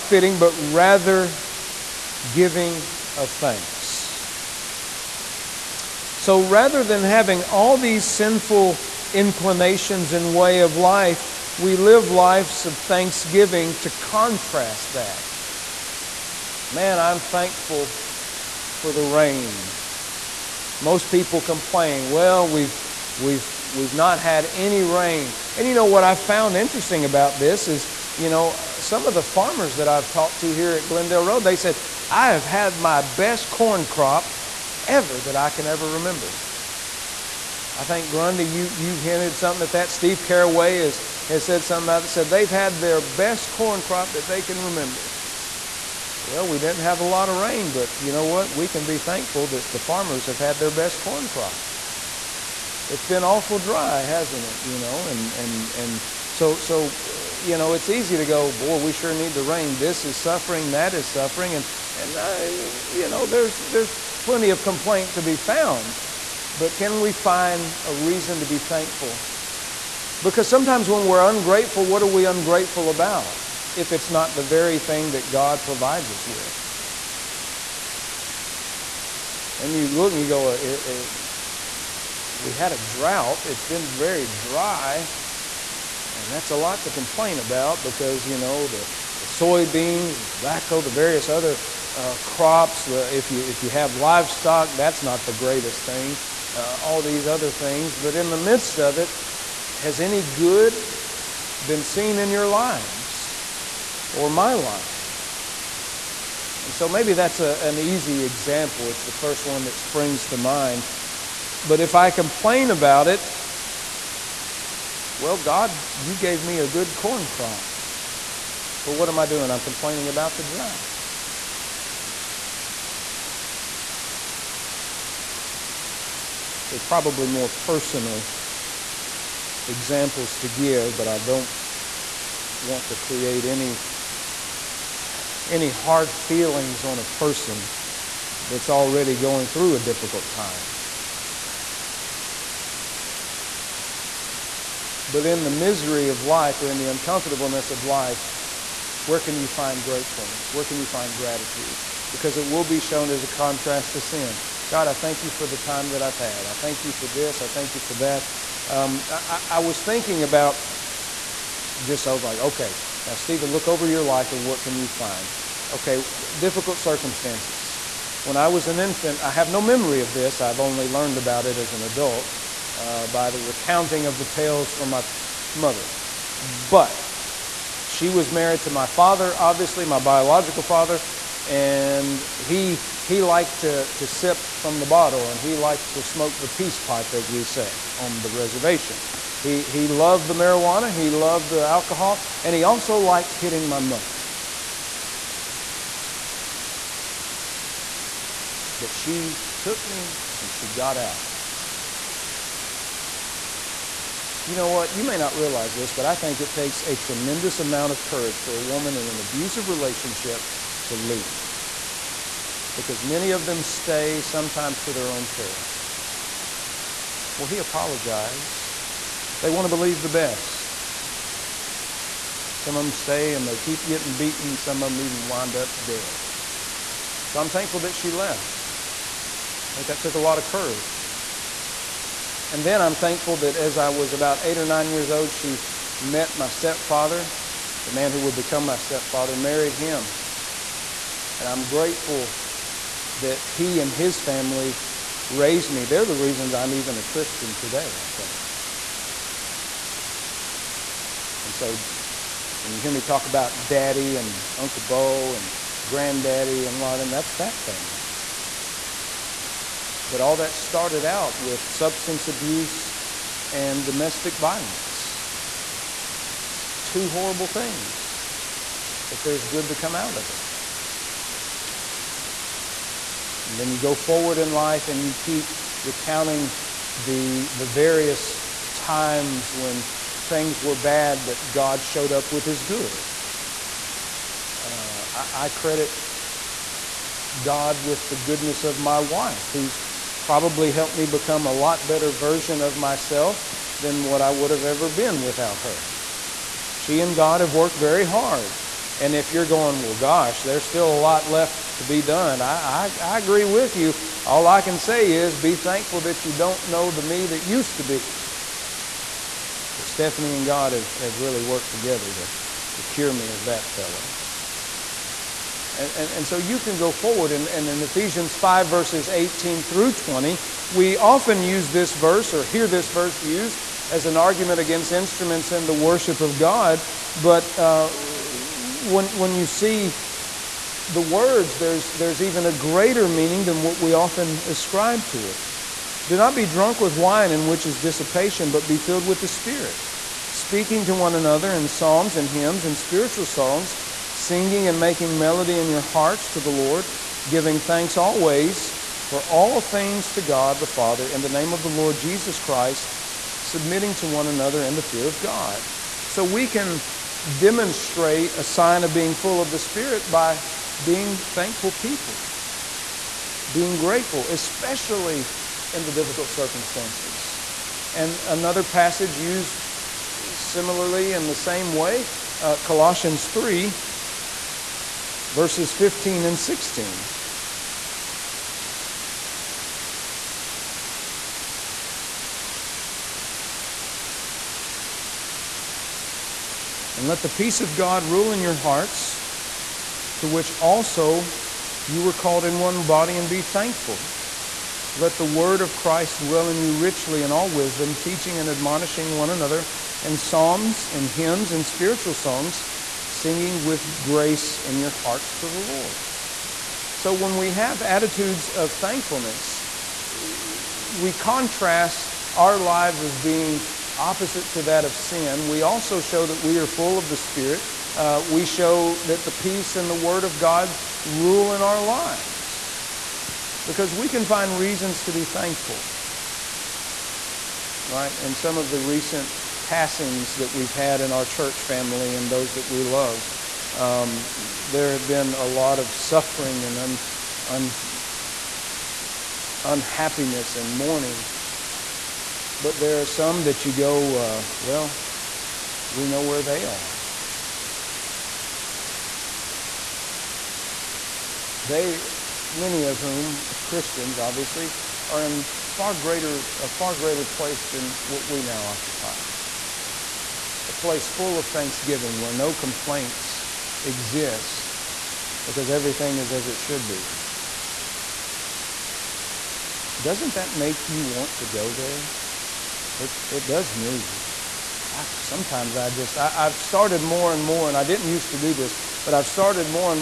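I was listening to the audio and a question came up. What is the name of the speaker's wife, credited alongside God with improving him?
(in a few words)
Stephanie.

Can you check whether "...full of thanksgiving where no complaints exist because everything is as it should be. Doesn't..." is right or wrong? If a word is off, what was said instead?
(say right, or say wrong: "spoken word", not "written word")
right.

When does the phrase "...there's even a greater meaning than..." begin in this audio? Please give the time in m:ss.
5:31.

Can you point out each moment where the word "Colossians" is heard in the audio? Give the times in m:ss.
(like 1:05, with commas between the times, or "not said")
6:12.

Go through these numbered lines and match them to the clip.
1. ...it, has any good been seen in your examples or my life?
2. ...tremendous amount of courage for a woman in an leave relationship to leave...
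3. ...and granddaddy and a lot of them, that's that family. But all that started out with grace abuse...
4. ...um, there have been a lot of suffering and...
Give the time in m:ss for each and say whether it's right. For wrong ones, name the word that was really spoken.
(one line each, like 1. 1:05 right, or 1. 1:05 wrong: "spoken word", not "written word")
1. 1:38 wrong: "lives", not "examples"
2. 3:26 wrong: "abusive", not "leave"
3. 4:15 wrong: "substance", not "grace"
4. 7:13 right.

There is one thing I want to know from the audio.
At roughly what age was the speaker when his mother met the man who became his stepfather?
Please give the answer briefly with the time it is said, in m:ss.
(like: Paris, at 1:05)
8 or 9, at 3:54.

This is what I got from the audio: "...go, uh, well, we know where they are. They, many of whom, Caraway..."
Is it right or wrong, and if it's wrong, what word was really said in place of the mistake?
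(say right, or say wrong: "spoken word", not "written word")
wrong: "Christians", not "Caraway".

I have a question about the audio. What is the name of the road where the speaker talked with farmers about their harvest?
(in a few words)
Glendale Road.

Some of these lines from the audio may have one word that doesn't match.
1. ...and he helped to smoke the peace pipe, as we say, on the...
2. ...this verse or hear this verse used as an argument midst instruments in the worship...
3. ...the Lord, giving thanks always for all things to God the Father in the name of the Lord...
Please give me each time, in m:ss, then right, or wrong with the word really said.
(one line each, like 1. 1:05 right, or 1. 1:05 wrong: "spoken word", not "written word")
1. 3:05 wrong: "liked", not "helped"
2. 5:21 wrong: "against", not "midst"
3. 5:46 right.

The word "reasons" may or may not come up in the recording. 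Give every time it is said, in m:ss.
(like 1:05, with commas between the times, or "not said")
1:07, 4:06, 7:04.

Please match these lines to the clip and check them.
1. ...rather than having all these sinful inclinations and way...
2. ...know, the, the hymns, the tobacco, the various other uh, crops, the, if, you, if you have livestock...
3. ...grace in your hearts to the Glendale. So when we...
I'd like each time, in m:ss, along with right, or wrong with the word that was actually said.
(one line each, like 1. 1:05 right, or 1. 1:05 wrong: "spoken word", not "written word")
1. 0:06 right
2. 1:28 wrong: "soybeans", not "hymns"
3. 6:43 wrong: "Lord", not "Glendale".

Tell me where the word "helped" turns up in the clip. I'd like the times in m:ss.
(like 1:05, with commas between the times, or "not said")
4:50.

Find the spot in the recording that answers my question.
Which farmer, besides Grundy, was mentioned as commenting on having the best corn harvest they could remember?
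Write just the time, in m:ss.
0:39.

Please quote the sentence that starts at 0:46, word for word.
Well, we didn't have a lot of rain, but you know what?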